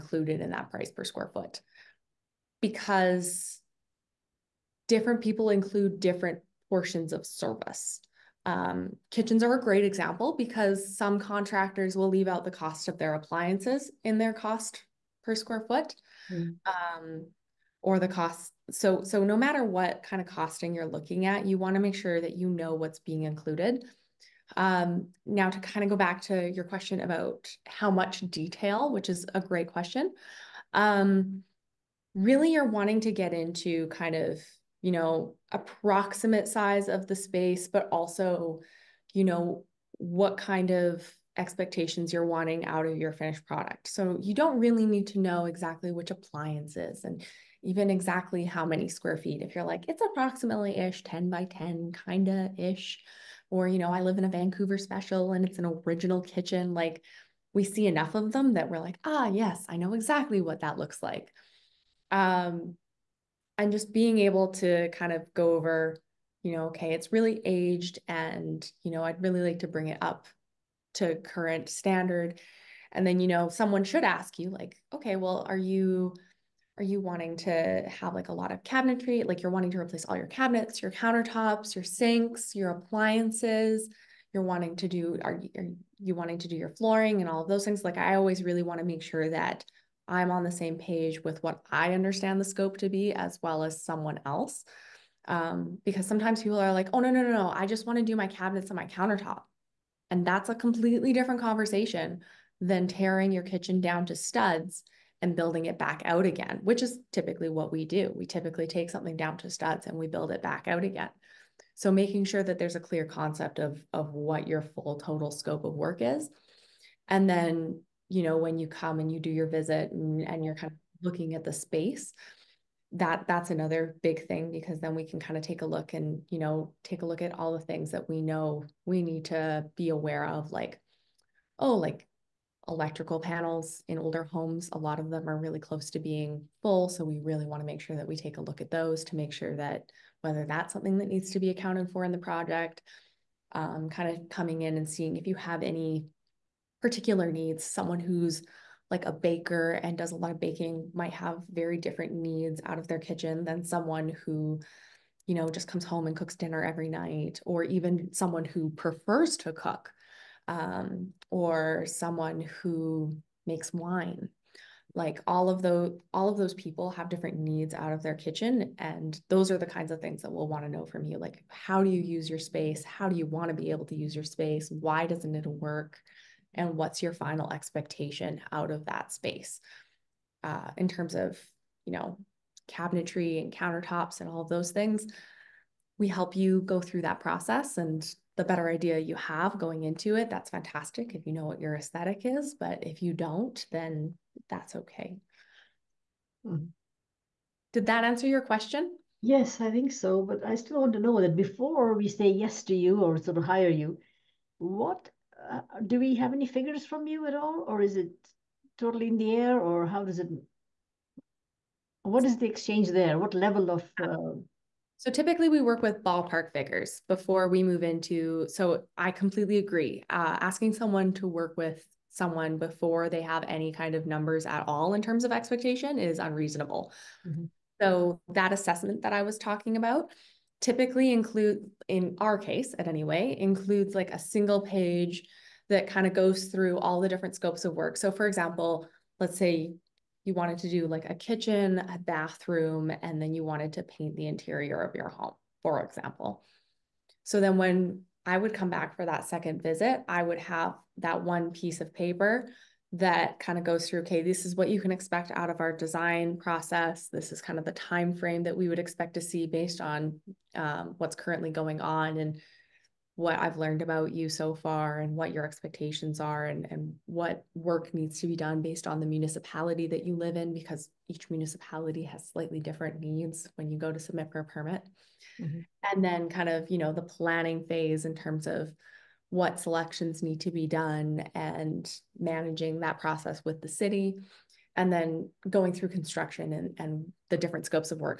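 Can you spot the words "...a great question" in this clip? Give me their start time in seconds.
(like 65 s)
29 s.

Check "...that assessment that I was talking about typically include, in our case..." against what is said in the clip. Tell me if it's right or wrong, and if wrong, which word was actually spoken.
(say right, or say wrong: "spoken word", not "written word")
right.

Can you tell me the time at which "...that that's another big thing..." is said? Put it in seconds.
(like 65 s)
122 s.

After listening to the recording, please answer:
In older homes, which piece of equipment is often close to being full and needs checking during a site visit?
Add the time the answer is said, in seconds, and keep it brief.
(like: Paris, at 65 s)
electrical panels, at 132 s.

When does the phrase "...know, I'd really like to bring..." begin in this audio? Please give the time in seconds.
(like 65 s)
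68 s.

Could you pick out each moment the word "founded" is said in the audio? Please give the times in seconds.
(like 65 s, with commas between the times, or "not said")
not said.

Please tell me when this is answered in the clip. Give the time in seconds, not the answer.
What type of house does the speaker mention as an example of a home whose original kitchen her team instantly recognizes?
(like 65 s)
54 s.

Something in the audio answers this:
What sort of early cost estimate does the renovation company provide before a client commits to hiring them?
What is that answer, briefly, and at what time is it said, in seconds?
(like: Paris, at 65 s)
ballpark figures, at 216 s.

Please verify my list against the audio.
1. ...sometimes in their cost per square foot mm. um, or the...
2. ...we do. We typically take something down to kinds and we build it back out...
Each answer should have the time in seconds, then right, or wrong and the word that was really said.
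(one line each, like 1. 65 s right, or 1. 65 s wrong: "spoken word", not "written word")
1. 13 s wrong: "appliances", not "sometimes"
2. 107 s wrong: "studs", not "kinds".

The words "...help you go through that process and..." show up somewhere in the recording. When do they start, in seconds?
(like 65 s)
186 s.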